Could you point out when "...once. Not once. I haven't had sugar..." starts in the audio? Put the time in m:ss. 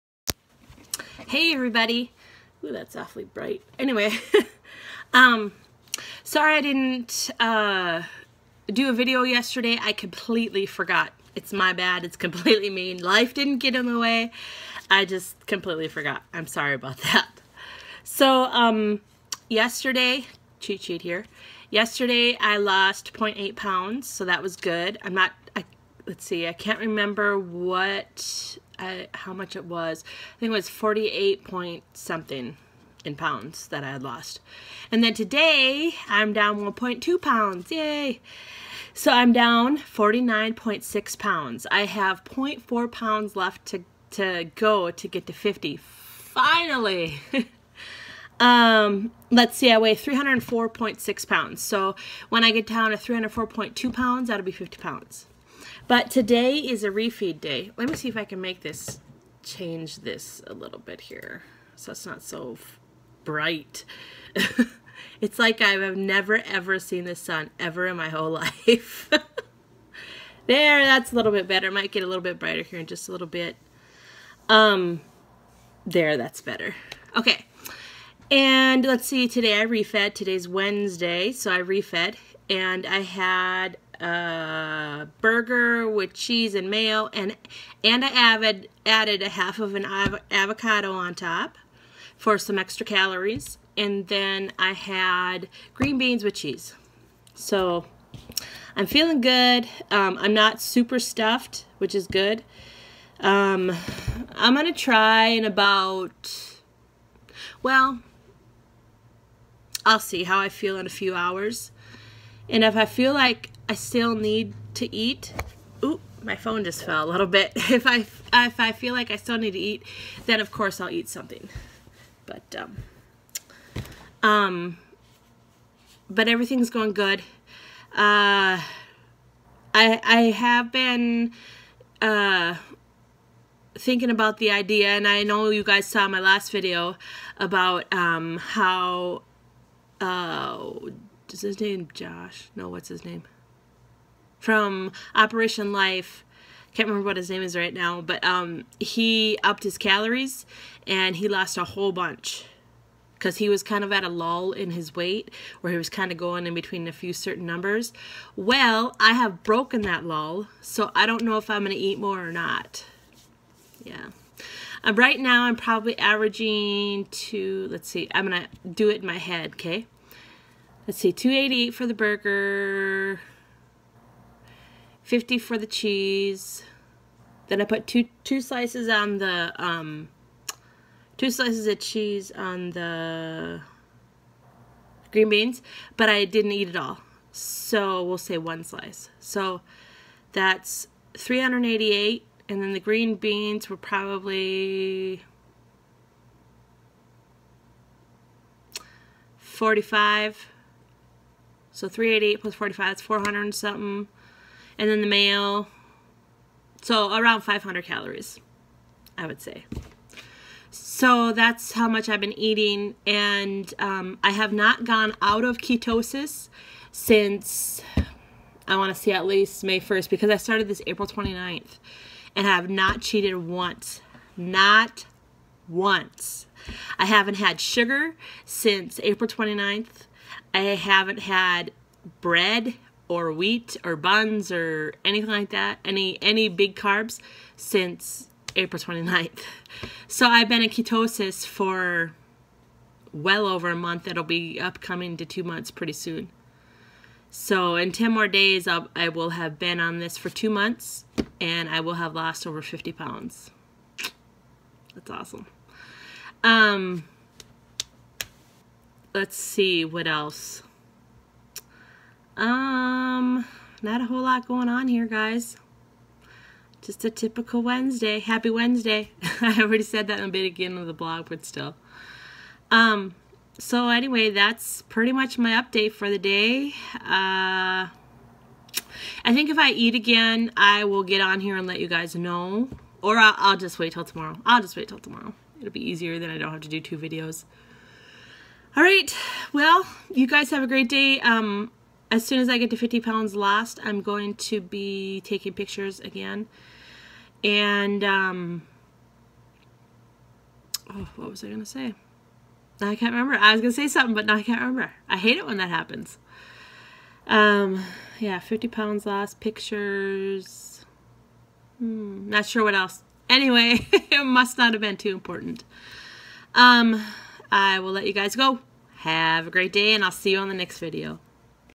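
3:43.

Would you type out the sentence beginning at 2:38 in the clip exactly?
Well, I have broken that lull, so I don't know if I'm going to eat more or not.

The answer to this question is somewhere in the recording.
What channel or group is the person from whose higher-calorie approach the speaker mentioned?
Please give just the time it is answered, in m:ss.
2:25.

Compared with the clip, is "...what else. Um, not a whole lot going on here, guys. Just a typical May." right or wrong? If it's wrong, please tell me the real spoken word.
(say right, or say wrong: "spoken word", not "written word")
wrong: "Wednesday", not "May".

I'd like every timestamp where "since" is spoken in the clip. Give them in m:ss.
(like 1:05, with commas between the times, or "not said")
3:36, 3:48, 3:57.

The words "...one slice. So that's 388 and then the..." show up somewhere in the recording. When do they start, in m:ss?
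3:08.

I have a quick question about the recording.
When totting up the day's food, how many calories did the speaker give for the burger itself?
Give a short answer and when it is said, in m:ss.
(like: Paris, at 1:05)
288, at 2:51.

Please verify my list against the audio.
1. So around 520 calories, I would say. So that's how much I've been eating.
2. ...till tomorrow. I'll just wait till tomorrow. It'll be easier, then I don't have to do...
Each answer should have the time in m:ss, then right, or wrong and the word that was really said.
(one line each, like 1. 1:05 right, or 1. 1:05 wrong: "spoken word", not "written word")
1. 3:26 wrong: "500", not "520"
2. 4:43 right.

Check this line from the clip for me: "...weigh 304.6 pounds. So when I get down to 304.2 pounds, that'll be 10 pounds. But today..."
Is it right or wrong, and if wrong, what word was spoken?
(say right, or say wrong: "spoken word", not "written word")
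wrong: "50", not "10".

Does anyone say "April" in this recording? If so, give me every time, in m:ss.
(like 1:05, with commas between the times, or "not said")
3:40, 3:49, 3:58.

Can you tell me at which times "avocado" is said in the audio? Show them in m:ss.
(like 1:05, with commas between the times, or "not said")
1:30.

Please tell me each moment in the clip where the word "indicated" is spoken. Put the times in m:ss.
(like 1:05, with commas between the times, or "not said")
not said.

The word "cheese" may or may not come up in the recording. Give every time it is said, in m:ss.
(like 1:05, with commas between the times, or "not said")
1:26, 1:36, 2:55, 3:01.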